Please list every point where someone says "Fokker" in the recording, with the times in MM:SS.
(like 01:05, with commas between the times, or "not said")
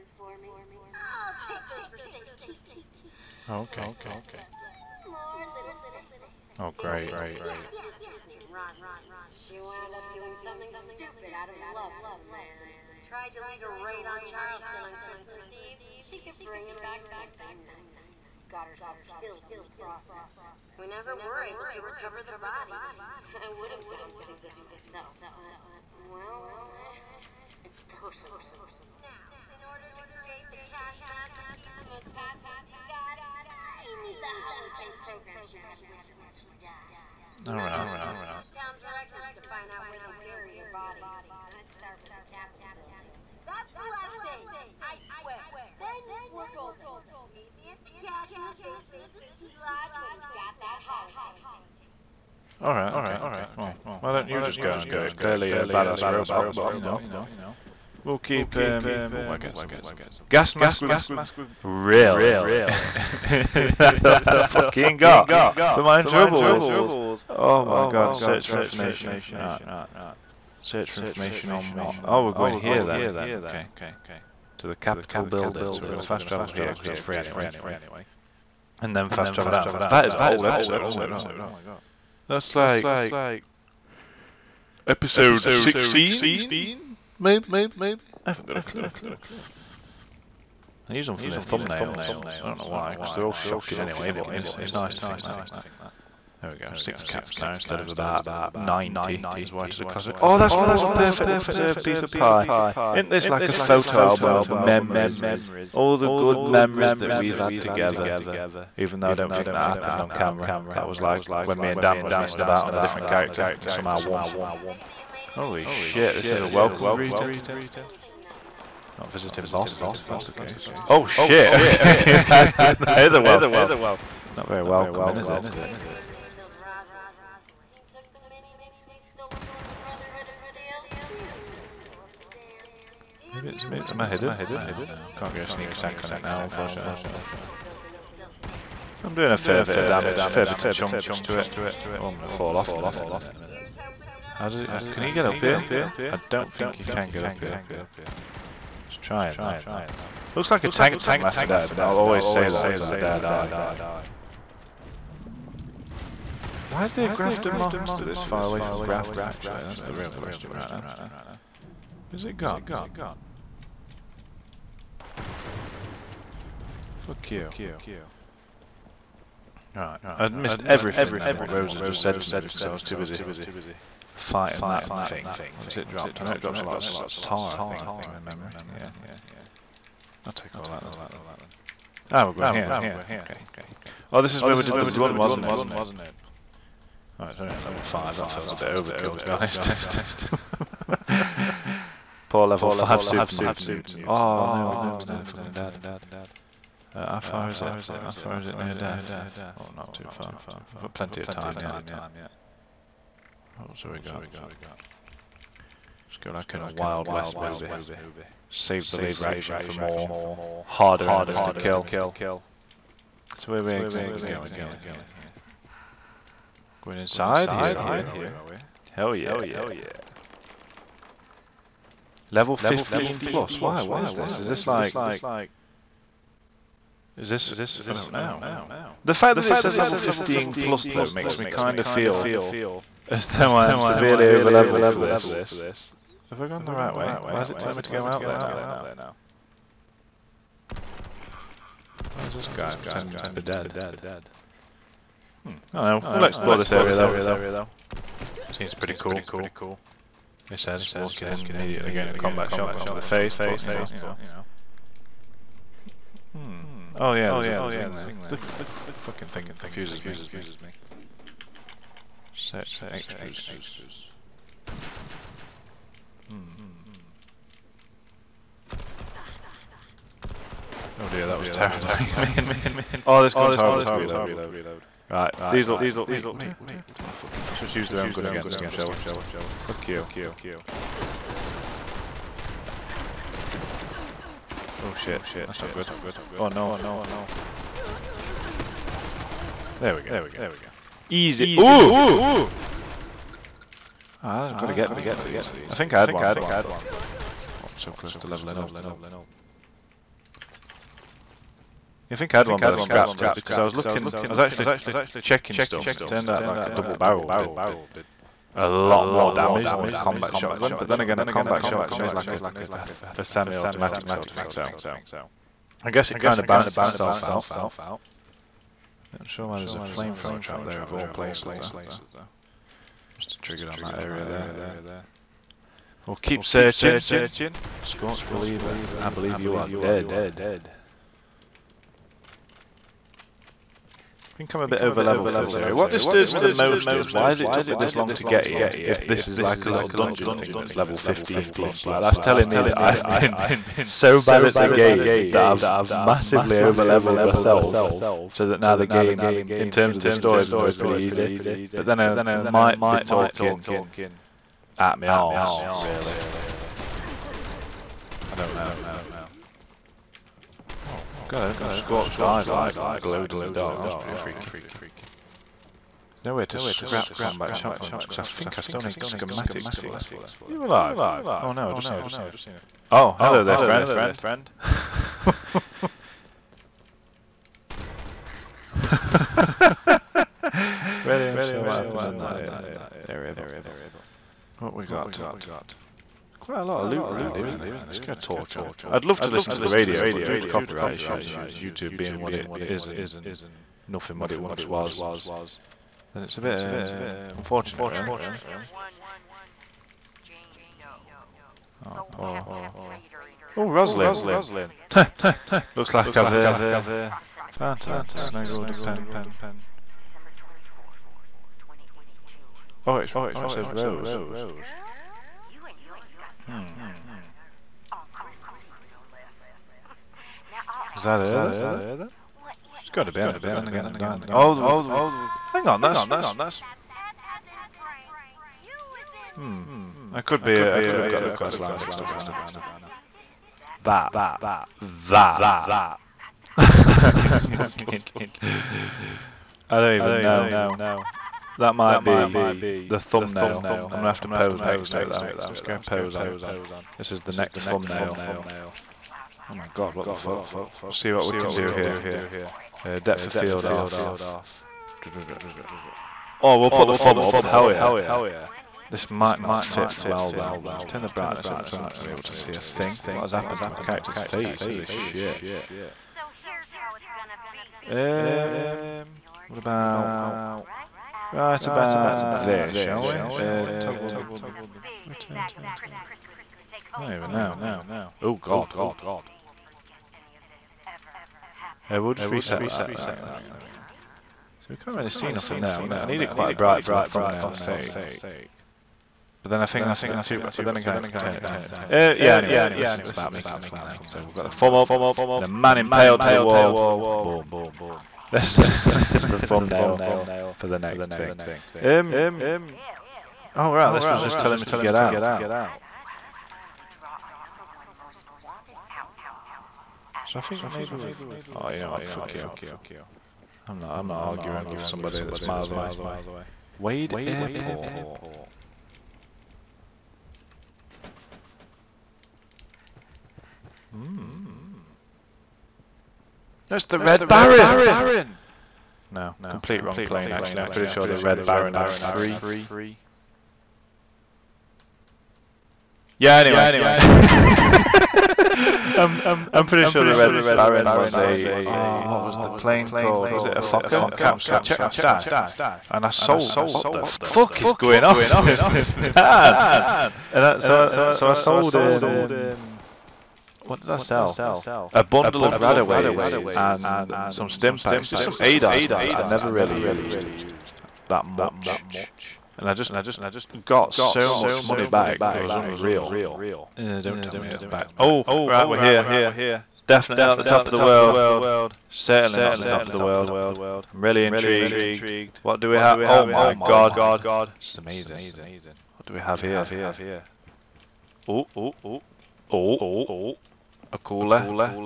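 09:03.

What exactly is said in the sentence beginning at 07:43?
What has happened to my character's face?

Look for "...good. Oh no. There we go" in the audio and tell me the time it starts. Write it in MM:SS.
04:45.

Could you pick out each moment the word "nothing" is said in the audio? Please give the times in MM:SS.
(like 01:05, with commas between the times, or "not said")
06:33, 08:05.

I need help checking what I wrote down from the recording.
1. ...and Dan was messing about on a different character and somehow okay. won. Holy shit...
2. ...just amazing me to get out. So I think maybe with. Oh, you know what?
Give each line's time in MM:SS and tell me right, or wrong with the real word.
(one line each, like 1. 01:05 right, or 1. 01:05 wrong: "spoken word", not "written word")
1. 01:51 right
2. 08:24 wrong: "telling", not "amazing".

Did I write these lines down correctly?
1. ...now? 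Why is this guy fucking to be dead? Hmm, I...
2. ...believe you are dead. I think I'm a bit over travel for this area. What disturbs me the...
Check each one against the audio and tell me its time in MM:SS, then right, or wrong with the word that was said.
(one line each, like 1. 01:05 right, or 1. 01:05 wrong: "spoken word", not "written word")
1. 03:58 wrong: "pretending", not "fucking"
2. 05:29 wrong: "level", not "travel".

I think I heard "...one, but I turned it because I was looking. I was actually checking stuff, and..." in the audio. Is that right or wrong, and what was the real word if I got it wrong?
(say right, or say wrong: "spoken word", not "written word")
wrong: "scrapped", not "turned".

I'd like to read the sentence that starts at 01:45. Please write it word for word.
All the good memories that we've had together.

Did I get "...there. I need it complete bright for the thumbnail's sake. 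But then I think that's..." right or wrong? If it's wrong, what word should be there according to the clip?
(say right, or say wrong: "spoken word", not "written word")
wrong: "quite", not "complete".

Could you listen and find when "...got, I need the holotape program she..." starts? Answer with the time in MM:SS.
00:32.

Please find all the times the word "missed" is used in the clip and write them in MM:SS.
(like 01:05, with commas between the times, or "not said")
02:50.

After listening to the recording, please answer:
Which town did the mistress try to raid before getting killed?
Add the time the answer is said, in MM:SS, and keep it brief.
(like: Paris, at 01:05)
Charleston, at 00:14.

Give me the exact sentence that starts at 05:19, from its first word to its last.
Not sure why there's a flamethrower trap there of all places, though.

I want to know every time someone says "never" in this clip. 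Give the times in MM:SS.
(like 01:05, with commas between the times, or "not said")
00:20, 09:19.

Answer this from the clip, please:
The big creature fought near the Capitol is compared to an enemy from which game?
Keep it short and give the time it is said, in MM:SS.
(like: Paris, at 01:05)
Left 4 Dead, at 02:31.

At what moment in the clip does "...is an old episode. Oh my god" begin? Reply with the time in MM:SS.
01:20.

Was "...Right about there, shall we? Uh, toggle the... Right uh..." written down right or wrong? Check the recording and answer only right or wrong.
right.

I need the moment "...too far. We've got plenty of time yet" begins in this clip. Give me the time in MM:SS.
03:19.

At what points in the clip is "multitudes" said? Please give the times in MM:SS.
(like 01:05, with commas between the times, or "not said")
not said.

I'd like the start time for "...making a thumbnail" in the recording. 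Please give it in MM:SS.
08:13.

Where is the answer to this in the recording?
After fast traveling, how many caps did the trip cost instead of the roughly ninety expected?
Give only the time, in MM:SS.
01:36.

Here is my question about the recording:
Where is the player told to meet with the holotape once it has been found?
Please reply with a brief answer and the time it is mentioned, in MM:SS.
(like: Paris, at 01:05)
the ski lodge, at 00:49.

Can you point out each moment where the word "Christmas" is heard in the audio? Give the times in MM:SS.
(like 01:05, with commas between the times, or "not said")
00:14, 06:58.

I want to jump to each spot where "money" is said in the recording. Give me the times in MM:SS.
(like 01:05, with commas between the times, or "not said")
09:24.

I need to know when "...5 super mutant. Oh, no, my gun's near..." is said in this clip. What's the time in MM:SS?
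03:12.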